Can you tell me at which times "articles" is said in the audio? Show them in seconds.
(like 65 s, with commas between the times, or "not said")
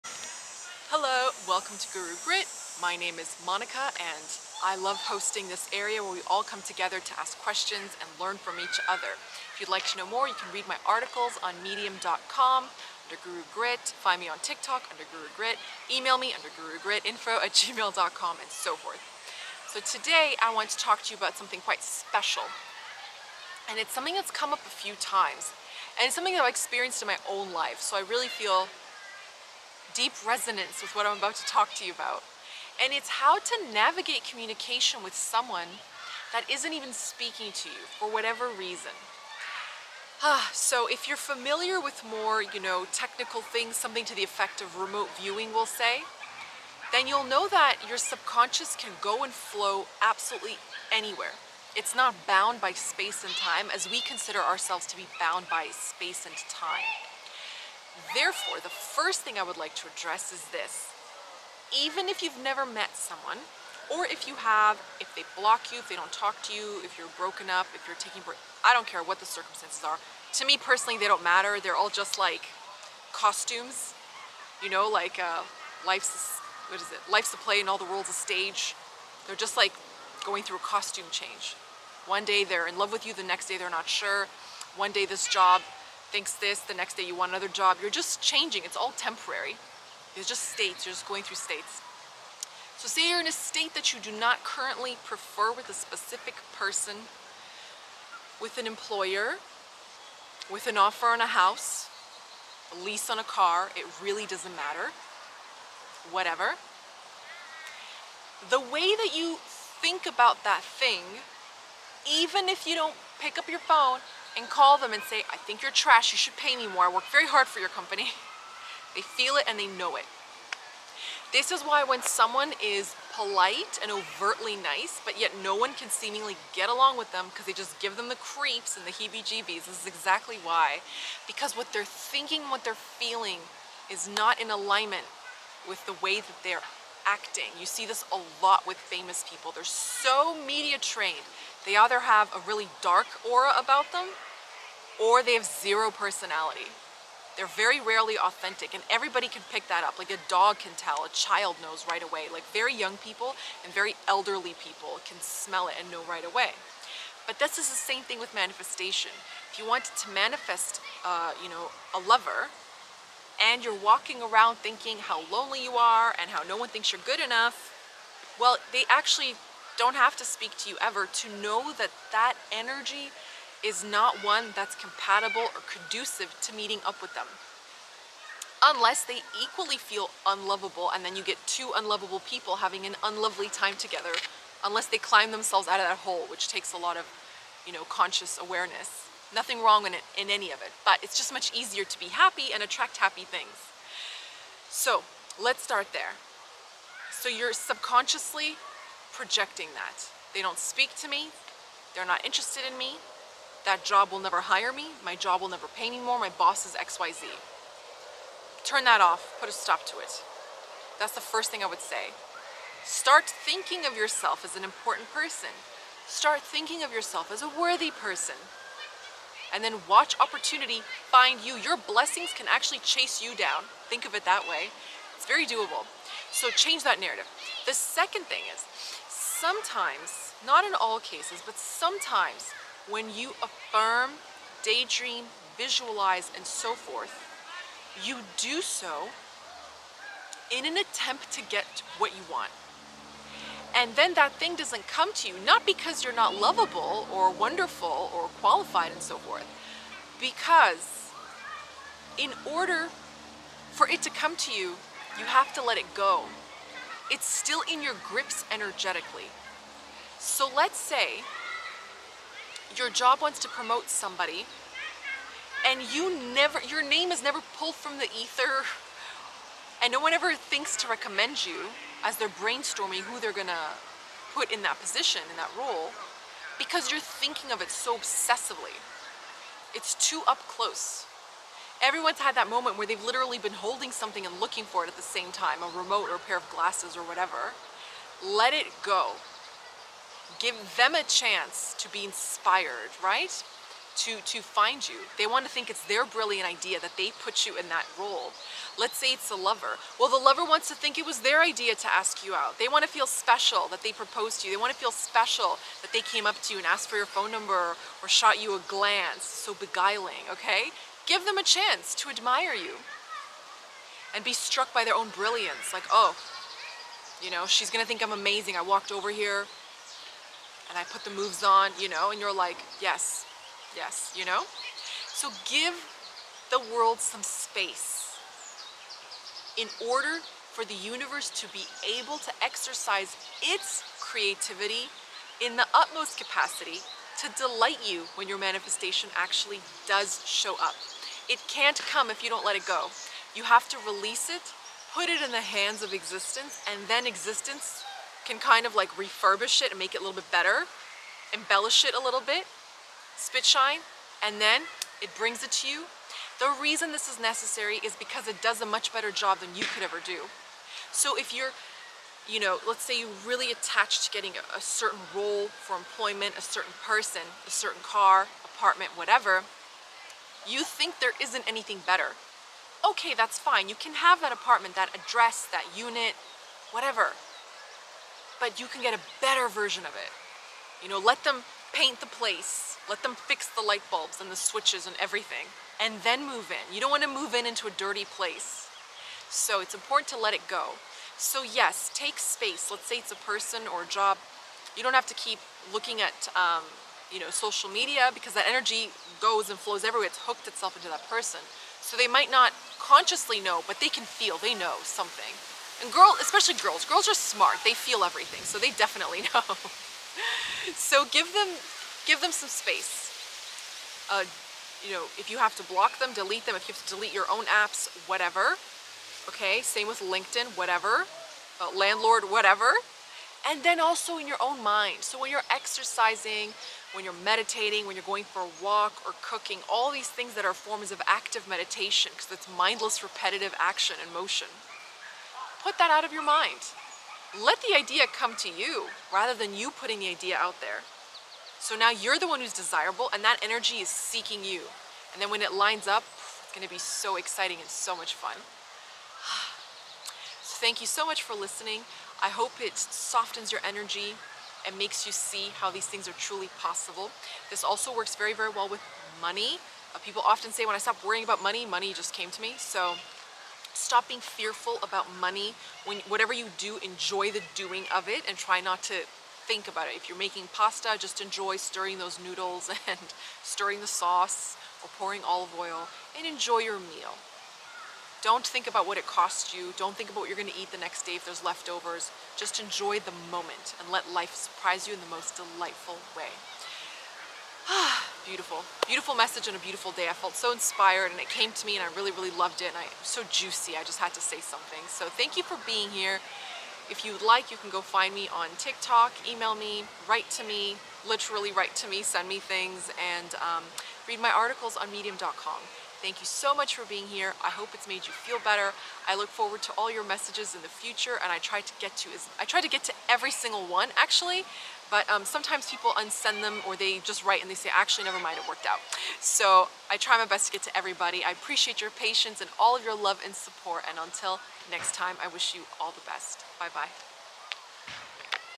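10 s, 504 s.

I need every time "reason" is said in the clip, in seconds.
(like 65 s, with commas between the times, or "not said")
38 s, 356 s.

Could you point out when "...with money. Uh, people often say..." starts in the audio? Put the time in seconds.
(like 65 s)
458 s.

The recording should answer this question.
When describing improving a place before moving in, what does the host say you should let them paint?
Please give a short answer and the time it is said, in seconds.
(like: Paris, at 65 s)
the place, at 381 s.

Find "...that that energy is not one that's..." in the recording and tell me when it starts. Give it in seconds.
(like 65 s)
171 s.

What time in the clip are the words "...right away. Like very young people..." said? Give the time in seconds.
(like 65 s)
151 s.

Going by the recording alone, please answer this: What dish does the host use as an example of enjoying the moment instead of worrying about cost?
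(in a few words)
pasta.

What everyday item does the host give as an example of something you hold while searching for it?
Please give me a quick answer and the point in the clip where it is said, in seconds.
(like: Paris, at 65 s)
a remote, at 285 s.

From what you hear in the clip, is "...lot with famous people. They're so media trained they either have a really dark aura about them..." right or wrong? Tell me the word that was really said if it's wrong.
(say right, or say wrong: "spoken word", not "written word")
right.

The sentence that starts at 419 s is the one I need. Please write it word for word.
Same with LinkedIn, whatever, uh, landlord, whatever.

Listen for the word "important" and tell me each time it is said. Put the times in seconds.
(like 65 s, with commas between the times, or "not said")
214 s, 389 s.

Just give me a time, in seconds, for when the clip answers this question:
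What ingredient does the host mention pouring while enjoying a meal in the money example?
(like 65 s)
475 s.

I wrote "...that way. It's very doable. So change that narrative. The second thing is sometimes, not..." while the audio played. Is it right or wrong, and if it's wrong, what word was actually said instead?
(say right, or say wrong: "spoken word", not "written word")
right.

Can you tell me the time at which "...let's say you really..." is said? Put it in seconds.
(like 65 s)
362 s.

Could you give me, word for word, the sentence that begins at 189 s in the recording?
Nothing wrong in, it, in any of it, but it's just much easier to be happy and attract happy things.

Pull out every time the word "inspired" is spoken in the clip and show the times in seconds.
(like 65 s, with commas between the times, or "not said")
292 s, 490 s.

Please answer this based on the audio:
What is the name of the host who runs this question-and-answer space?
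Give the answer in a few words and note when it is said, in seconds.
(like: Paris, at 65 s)
Monika, at 3 s.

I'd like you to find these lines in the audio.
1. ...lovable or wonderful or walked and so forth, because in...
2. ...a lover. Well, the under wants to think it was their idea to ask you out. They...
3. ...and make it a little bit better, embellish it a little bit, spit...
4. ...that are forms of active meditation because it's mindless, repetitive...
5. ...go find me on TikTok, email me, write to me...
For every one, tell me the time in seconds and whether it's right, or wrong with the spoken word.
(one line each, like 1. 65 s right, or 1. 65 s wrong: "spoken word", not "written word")
1. 246 s wrong: "qualified", not "walked"
2. 299 s wrong: "lover", not "under"
3. 349 s right
4. 430 s right
5. 497 s right.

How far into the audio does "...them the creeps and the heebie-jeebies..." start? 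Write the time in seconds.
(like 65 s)
127 s.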